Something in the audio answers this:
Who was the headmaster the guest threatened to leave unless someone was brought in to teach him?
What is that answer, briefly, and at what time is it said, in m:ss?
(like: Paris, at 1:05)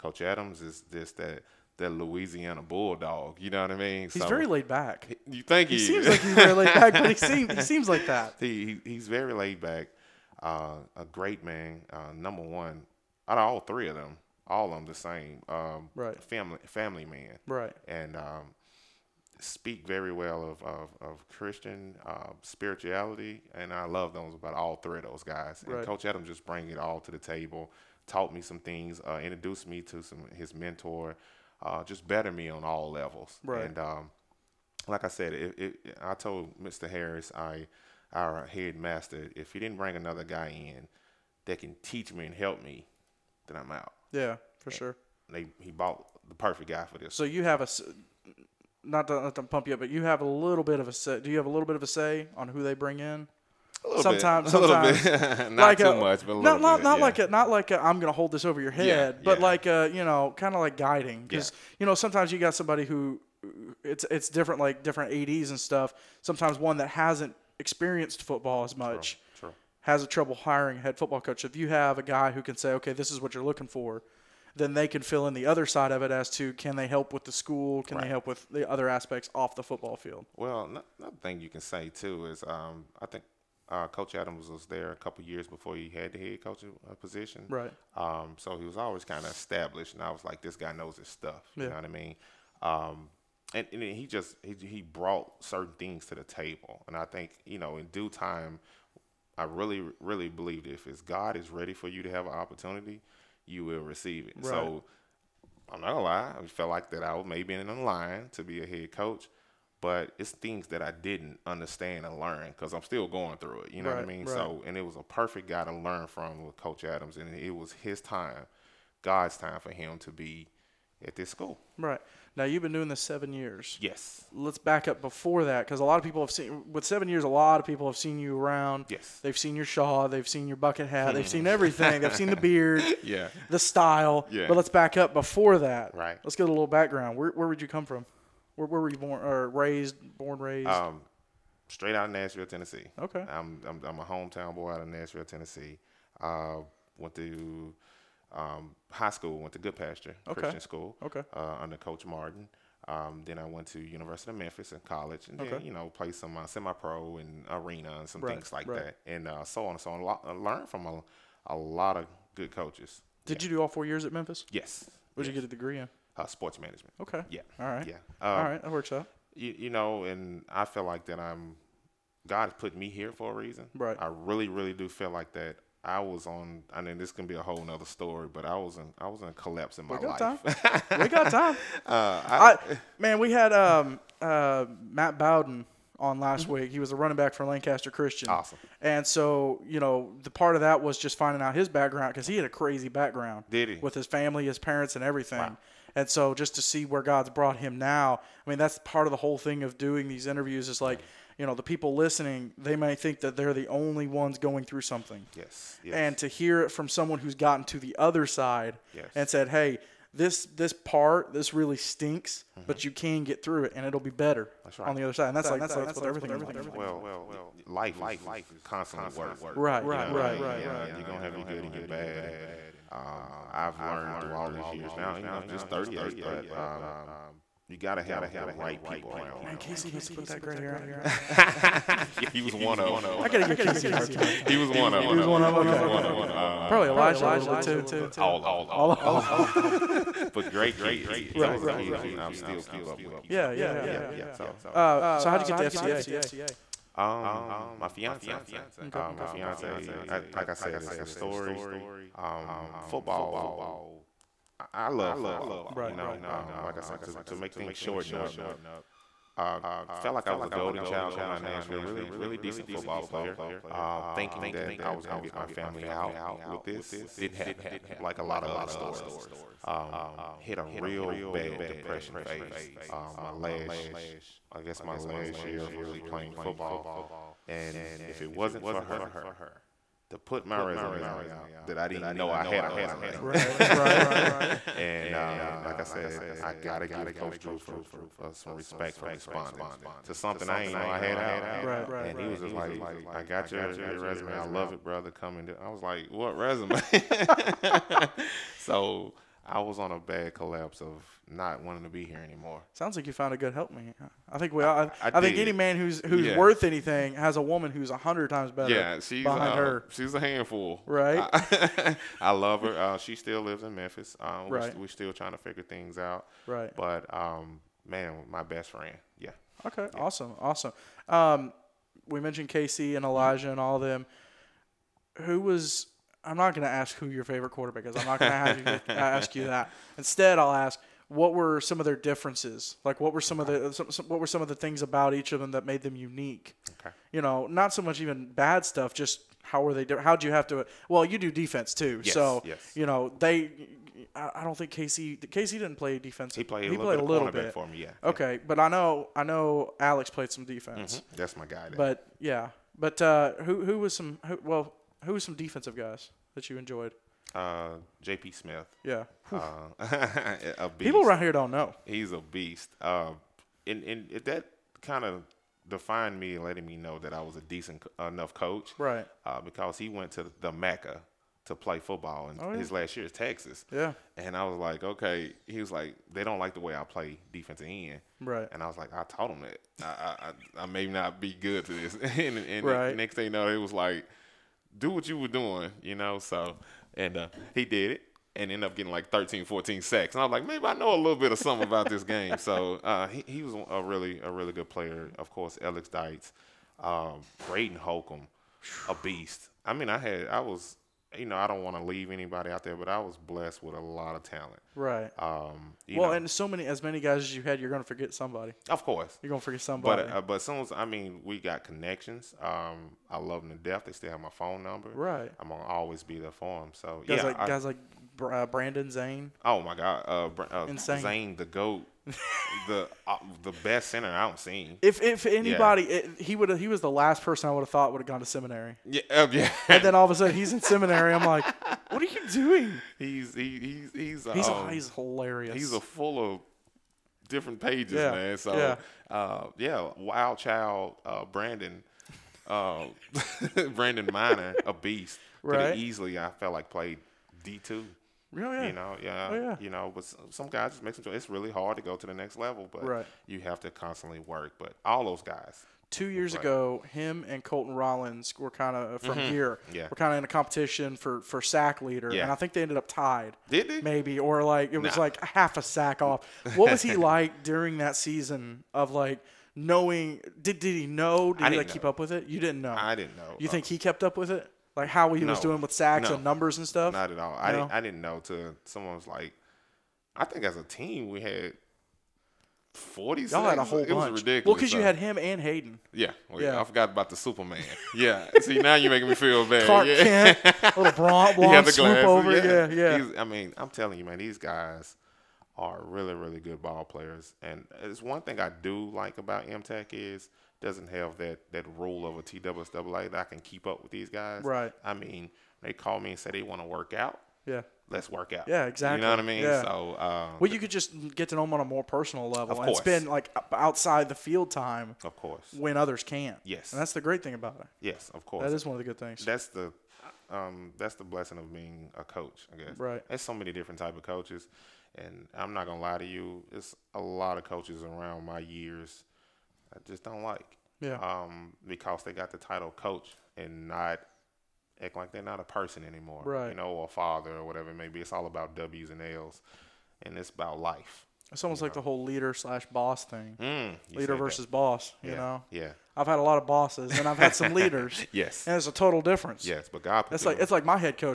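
Mr. Harris, at 0:36.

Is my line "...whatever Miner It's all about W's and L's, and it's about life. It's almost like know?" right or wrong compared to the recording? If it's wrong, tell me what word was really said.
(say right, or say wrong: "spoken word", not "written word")
wrong: "Maybe", not "Miner".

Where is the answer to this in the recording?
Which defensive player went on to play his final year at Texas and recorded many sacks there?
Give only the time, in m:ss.
5:58.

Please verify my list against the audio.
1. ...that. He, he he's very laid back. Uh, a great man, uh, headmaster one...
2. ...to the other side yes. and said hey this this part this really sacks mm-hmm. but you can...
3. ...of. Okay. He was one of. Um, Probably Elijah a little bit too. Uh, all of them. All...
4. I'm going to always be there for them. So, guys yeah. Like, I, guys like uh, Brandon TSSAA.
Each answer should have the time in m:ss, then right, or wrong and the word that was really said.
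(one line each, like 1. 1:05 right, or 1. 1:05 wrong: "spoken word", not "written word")
1. 0:08 wrong: "number", not "headmaster"
2. 3:27 wrong: "stinks", not "sacks"
3. 3:55 right
4. 6:55 wrong: "Zane", not "TSSAA".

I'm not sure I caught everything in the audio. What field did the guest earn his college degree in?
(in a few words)
Sports management.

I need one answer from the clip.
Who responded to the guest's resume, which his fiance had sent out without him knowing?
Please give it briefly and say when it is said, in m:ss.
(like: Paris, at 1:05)
Coach Drew, at 4:47.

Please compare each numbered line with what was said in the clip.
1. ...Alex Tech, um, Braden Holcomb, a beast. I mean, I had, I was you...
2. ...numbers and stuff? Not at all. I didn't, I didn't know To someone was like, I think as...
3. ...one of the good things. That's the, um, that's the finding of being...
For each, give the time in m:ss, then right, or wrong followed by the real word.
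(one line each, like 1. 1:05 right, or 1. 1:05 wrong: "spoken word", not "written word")
1. 6:35 wrong: "Dykes", not "Tech"
2. 7:56 right
3. 8:38 wrong: "blessing", not "finding".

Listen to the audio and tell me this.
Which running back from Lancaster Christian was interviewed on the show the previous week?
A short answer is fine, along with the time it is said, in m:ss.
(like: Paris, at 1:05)
Matt Bowden, at 3:04.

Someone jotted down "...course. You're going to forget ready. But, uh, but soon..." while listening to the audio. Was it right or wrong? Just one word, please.
wrong.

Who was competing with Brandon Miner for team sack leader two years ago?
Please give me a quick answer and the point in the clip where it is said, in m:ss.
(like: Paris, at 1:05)
Colton Rollins, at 7:37.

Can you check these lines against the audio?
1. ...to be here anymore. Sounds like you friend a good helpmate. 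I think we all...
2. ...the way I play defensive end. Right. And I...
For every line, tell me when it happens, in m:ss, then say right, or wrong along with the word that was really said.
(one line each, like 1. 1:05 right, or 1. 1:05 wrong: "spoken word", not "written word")
1. 5:01 wrong: "found", not "friend"
2. 6:16 right.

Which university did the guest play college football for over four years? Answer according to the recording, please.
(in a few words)
University of Memphis.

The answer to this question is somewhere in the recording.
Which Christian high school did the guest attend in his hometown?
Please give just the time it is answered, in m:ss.
2:29.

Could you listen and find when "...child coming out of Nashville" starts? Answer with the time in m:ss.
4:20.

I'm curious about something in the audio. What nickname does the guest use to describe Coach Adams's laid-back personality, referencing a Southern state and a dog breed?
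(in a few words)
Louisiana bulldog.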